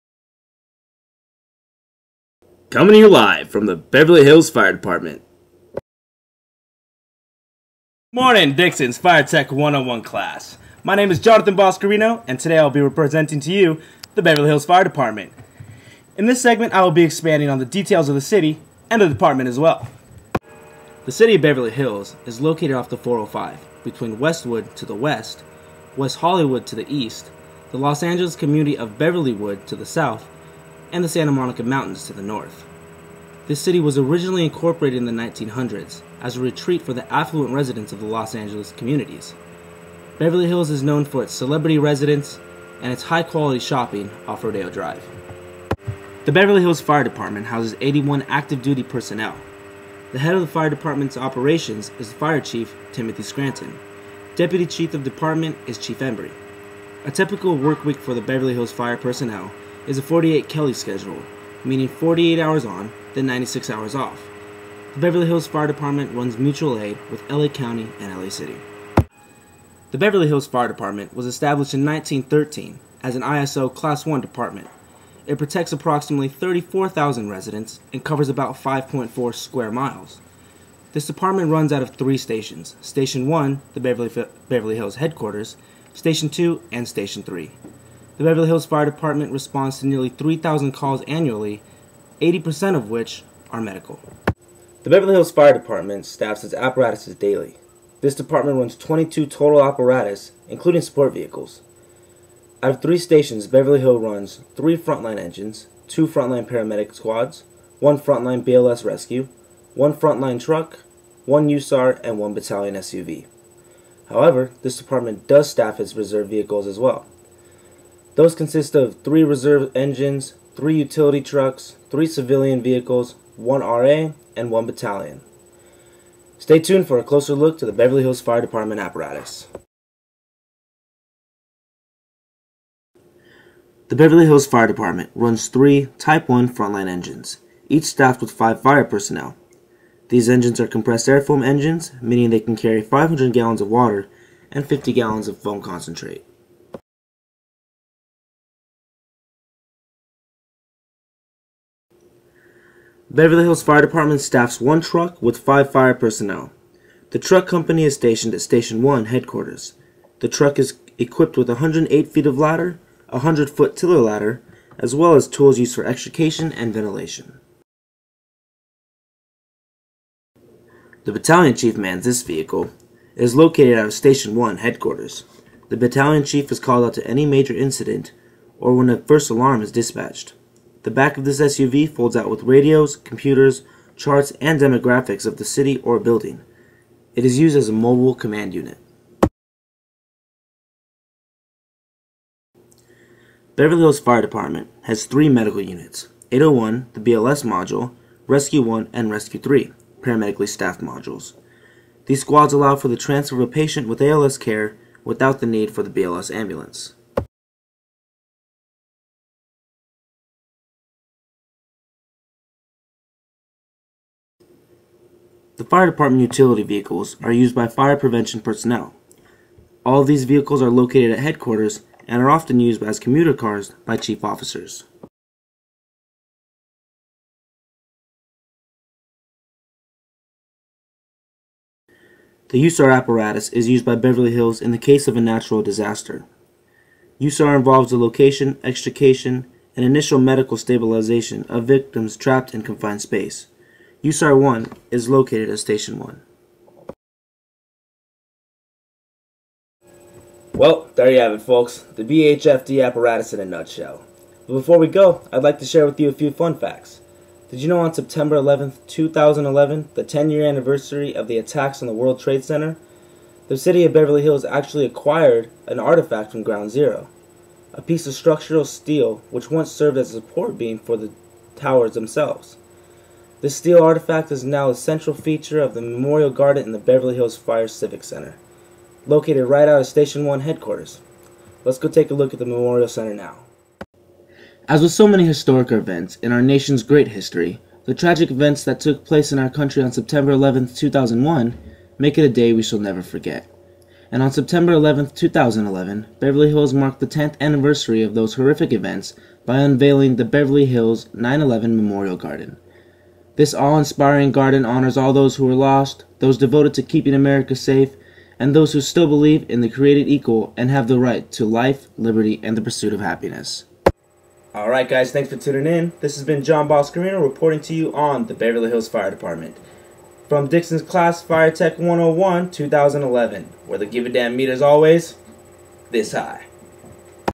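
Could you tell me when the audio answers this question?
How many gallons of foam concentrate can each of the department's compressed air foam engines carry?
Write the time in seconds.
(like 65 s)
144 s.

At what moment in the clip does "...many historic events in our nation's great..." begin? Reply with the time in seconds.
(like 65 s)
285 s.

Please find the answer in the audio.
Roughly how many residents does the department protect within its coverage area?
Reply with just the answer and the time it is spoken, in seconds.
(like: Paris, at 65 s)
34,000, at 76 s.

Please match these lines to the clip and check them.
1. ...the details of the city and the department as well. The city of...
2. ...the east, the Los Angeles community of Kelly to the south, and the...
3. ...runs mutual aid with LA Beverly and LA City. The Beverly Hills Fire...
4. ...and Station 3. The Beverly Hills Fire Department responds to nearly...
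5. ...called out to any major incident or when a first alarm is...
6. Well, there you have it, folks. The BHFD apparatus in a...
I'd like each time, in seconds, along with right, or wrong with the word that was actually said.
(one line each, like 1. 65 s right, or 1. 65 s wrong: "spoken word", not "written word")
1. 17 s right
2. 26 s wrong: "Beverlywood", not "Kelly"
3. 66 s wrong: "County", not "Beverly"
4. 86 s right
5. 176 s right
6. 250 s right.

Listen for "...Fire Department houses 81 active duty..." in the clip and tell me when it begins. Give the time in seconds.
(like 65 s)
46 s.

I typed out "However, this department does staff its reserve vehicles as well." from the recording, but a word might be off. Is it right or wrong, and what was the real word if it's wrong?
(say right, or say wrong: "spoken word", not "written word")
right.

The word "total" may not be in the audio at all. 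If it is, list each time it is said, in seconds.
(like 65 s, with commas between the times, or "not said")
99 s.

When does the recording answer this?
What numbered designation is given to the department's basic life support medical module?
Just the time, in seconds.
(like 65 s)
196 s.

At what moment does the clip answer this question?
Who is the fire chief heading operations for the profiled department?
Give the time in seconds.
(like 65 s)
52 s.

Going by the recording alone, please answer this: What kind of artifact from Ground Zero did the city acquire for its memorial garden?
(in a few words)
Structural steel.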